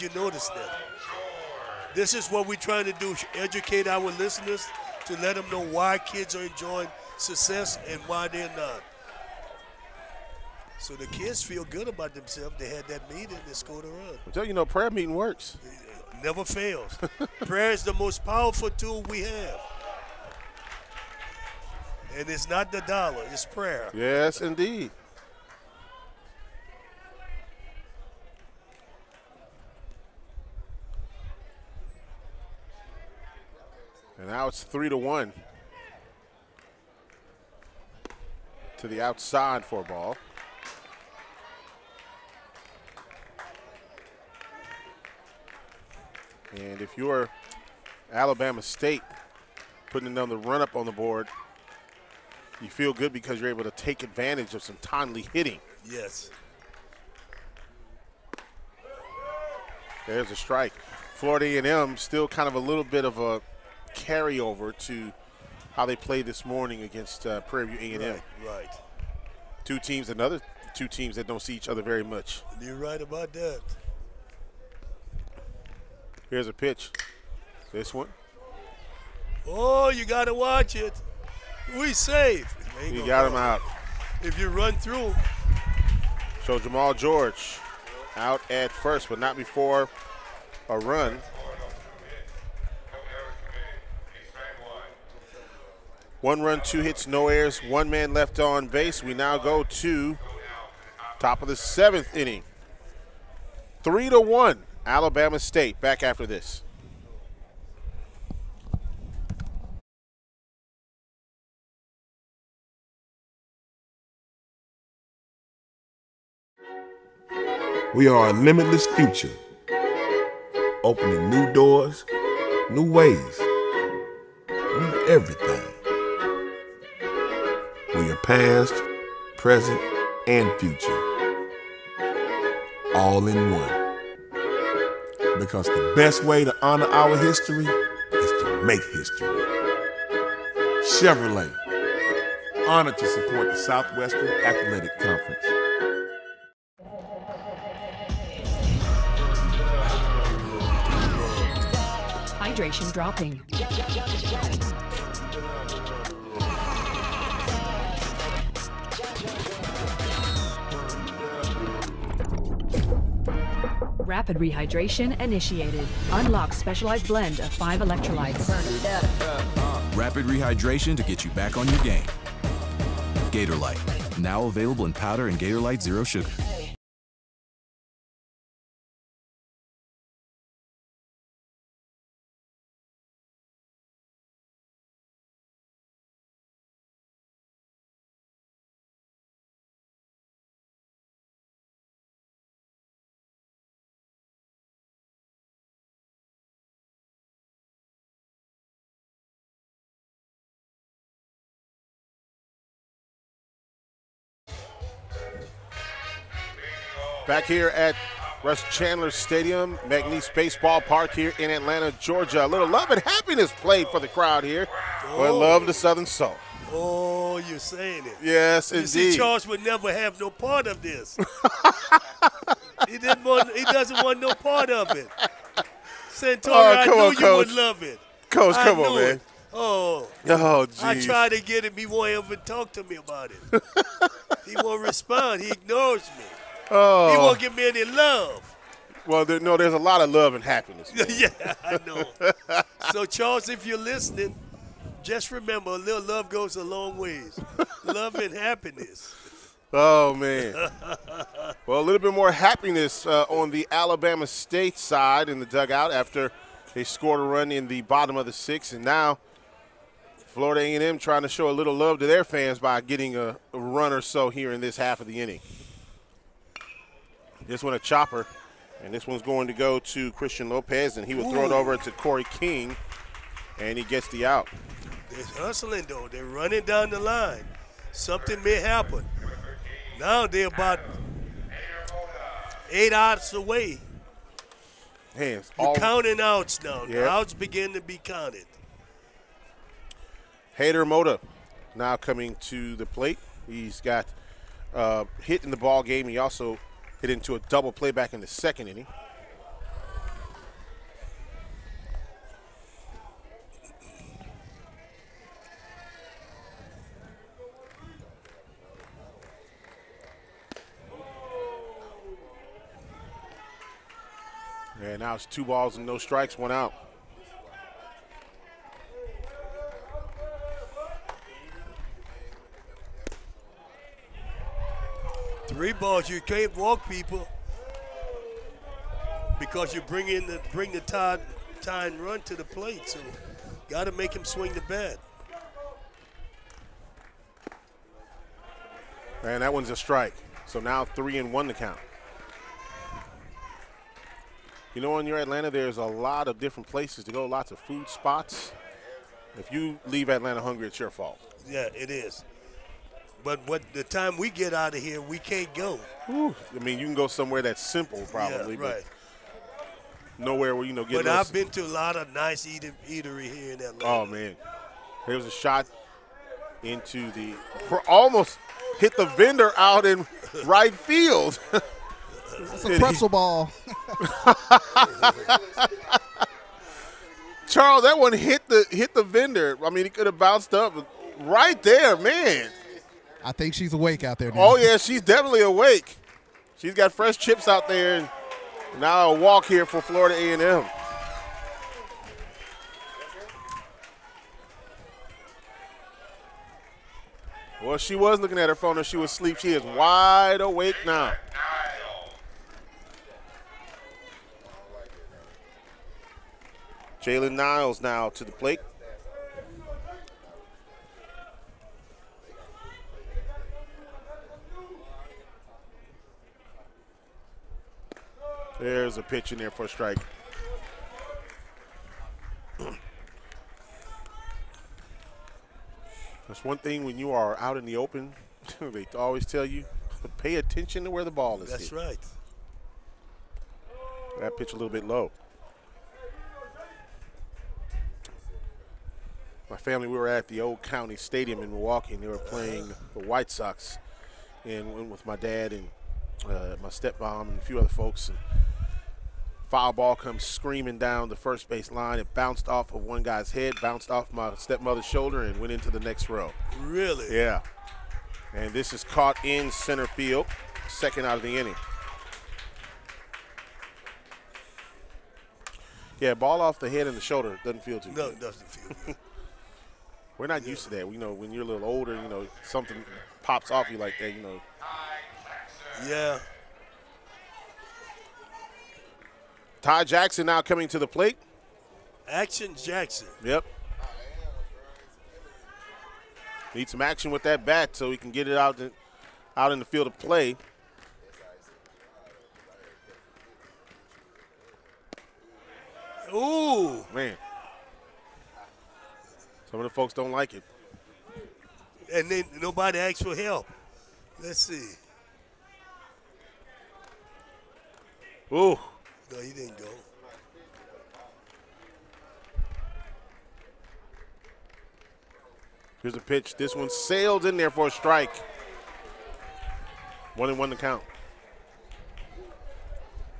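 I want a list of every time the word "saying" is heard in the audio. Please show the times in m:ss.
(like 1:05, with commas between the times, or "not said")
3:37.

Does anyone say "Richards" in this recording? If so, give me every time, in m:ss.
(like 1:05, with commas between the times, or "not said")
not said.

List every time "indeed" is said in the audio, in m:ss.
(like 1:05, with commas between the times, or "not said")
0:24, 3:38.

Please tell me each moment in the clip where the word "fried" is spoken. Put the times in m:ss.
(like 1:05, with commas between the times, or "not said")
not said.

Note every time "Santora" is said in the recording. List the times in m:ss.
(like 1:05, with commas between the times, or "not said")
3:46.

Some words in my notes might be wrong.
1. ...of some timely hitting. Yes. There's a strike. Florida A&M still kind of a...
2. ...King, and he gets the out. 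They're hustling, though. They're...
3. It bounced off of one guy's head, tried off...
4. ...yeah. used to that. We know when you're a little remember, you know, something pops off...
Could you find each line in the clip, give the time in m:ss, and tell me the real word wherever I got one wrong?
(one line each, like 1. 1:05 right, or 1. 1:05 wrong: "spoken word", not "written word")
1. 0:54 right
2. 4:32 right
3. 7:31 wrong: "bounced", not "tried"
4. 7:50 wrong: "older", not "remember".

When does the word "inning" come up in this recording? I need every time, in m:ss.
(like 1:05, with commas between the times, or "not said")
1:42, 4:25, 4:58, 7:41.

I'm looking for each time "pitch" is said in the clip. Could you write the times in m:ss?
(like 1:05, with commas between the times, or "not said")
1:16, 6:59, 7:14, 8:35.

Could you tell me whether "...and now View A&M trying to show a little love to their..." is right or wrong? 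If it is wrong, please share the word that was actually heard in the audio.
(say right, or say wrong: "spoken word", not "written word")
wrong: "Florida", not "View".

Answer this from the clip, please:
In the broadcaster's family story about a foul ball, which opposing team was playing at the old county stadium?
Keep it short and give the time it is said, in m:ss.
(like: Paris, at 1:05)
White Sox, at 7:23.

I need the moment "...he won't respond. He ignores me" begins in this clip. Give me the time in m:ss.
3:54.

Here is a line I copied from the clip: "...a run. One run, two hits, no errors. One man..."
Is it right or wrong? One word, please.
right.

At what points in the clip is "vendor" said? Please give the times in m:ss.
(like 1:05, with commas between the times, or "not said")
6:09, 6:19.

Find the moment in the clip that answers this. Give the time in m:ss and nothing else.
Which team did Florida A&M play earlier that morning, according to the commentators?
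1:07.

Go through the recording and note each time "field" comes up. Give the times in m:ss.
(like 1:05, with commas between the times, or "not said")
6:10, 7:39, 8:09.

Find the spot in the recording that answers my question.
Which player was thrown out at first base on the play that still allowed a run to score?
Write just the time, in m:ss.
1:26.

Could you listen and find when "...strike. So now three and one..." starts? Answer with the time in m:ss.
5:39.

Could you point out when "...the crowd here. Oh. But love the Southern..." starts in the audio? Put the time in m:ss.
3:33.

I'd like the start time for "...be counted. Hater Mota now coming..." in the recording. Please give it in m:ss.
4:47.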